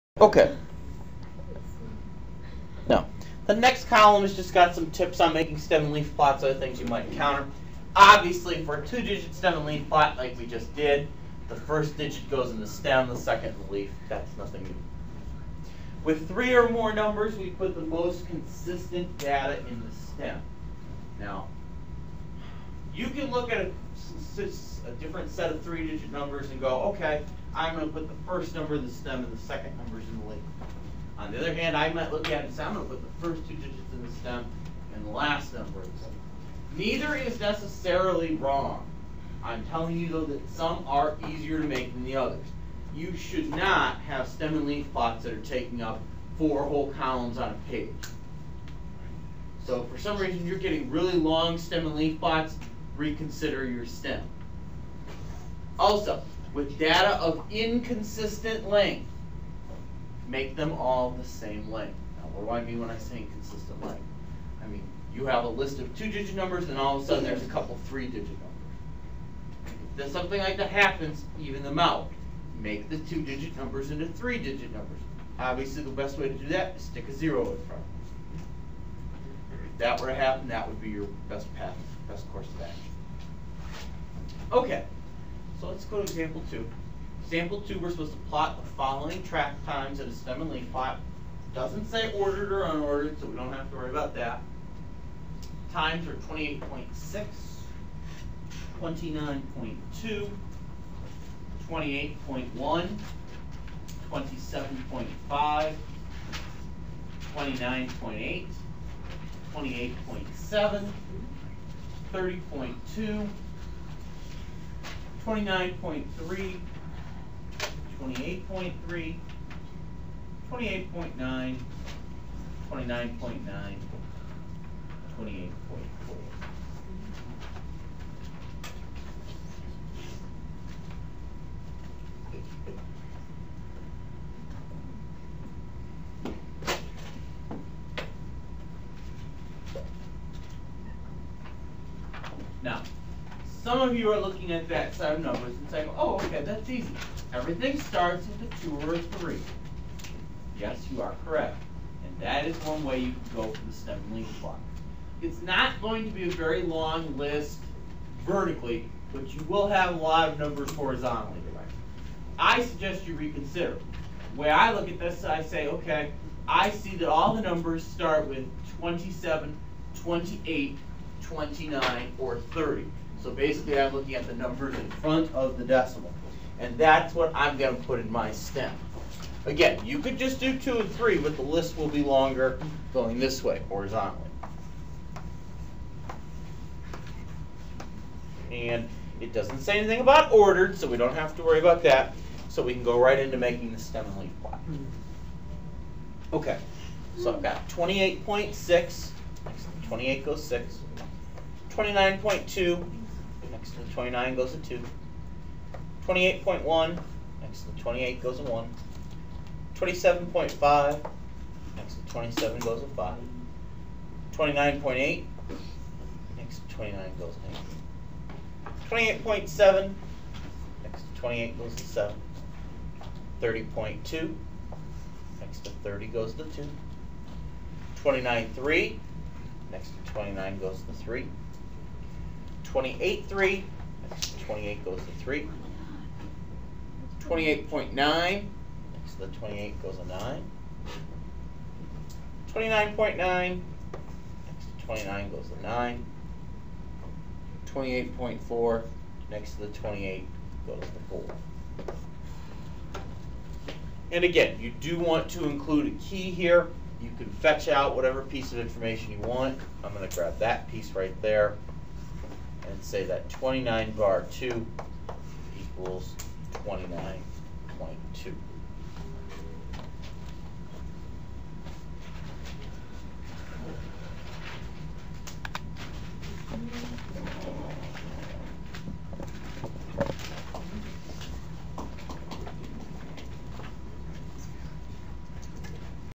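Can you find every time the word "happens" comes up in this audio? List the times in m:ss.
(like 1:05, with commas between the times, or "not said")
1:10, 1:20.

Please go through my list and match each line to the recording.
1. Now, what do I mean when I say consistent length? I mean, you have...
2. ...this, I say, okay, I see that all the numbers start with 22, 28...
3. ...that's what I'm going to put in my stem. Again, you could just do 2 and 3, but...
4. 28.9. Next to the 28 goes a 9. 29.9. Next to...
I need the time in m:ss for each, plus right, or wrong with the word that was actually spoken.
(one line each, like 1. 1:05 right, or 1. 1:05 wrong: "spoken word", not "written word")
1. 1:02 wrong: "inconsistent", not "consistent"
2. 2:44 wrong: "27", not "22"
3. 2:56 right
4. 3:57 right.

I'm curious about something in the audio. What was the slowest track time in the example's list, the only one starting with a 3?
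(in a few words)
30.2.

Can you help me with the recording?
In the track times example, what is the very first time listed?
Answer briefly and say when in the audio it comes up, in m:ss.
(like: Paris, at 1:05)
28.6, at 1:35.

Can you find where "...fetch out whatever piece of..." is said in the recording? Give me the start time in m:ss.
4:17.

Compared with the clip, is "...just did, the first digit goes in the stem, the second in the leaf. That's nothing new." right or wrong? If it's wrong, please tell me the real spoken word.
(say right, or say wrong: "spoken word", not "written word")
right.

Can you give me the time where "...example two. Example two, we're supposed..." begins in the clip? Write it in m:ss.
1:26.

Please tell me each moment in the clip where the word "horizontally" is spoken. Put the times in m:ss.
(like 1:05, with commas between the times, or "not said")
2:40, 3:03.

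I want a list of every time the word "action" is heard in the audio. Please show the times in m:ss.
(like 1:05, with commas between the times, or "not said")
1:22.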